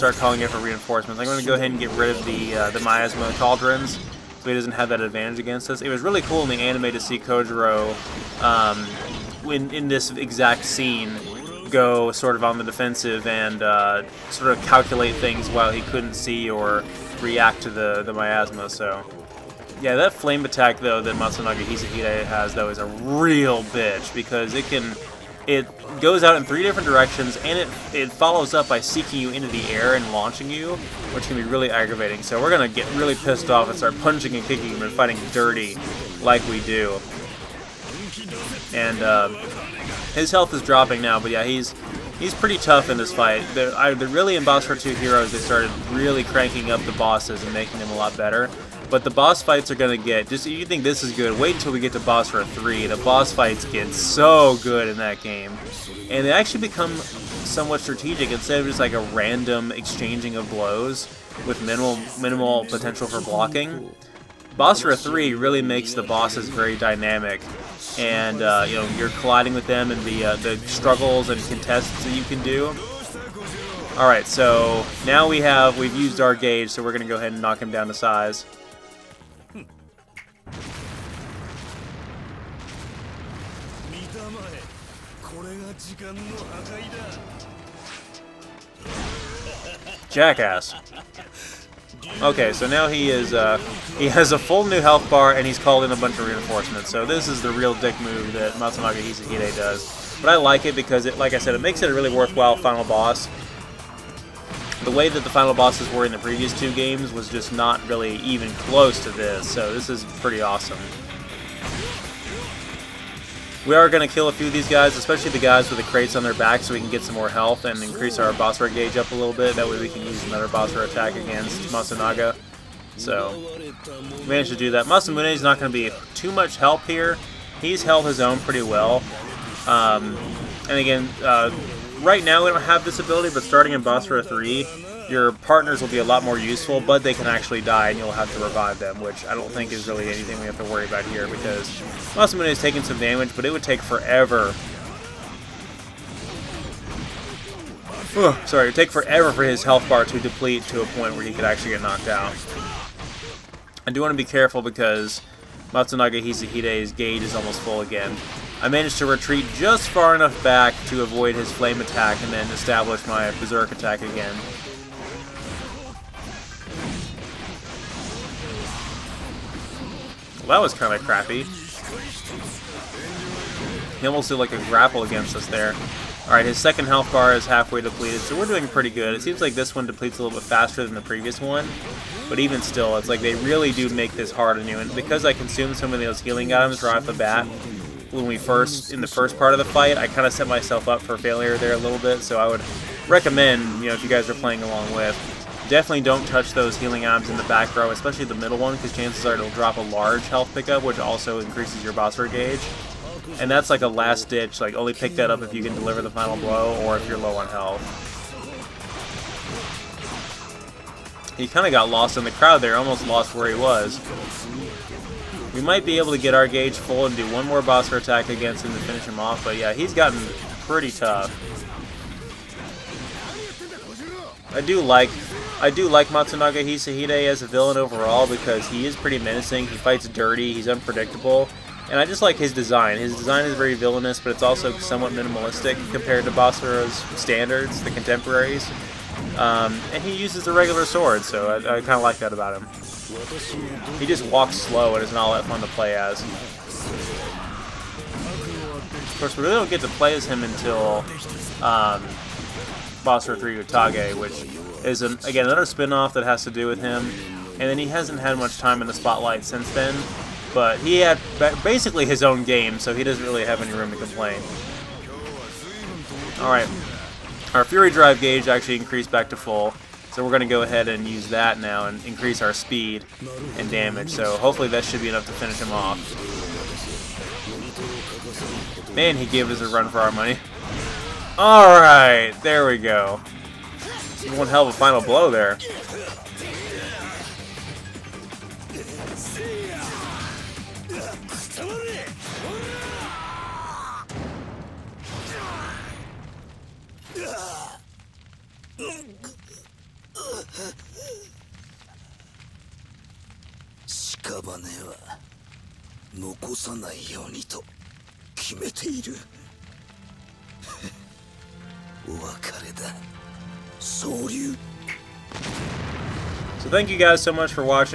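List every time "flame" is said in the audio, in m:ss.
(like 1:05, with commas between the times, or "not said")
0:20, 2:41.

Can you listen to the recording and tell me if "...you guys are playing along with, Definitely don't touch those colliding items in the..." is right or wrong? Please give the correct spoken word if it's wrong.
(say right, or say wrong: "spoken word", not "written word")
wrong: "healing", not "colliding".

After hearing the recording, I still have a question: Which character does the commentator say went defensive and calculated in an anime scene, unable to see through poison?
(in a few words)
Kojuro.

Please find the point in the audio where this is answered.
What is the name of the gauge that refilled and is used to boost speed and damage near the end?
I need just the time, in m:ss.
4:27.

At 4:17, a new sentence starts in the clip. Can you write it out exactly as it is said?
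And then he hasn't had much time in the spotlight since then.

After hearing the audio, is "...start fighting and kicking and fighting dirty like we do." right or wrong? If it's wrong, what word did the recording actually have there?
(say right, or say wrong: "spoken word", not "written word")
wrong: "punching", not "fighting".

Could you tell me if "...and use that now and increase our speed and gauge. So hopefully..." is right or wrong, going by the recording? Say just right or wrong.
wrong.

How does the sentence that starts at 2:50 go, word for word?
Well, that was kind of crappy.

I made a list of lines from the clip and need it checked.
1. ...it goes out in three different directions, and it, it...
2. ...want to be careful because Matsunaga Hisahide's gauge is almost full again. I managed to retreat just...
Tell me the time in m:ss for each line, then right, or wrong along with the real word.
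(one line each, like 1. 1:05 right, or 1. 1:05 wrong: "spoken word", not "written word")
1. 0:25 right
2. 2:34 right.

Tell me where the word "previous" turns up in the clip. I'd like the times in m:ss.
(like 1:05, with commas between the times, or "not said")
1:46, 3:01.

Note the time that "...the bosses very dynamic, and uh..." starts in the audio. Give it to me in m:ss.
1:05.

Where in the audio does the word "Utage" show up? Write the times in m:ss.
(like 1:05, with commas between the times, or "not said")
4:13.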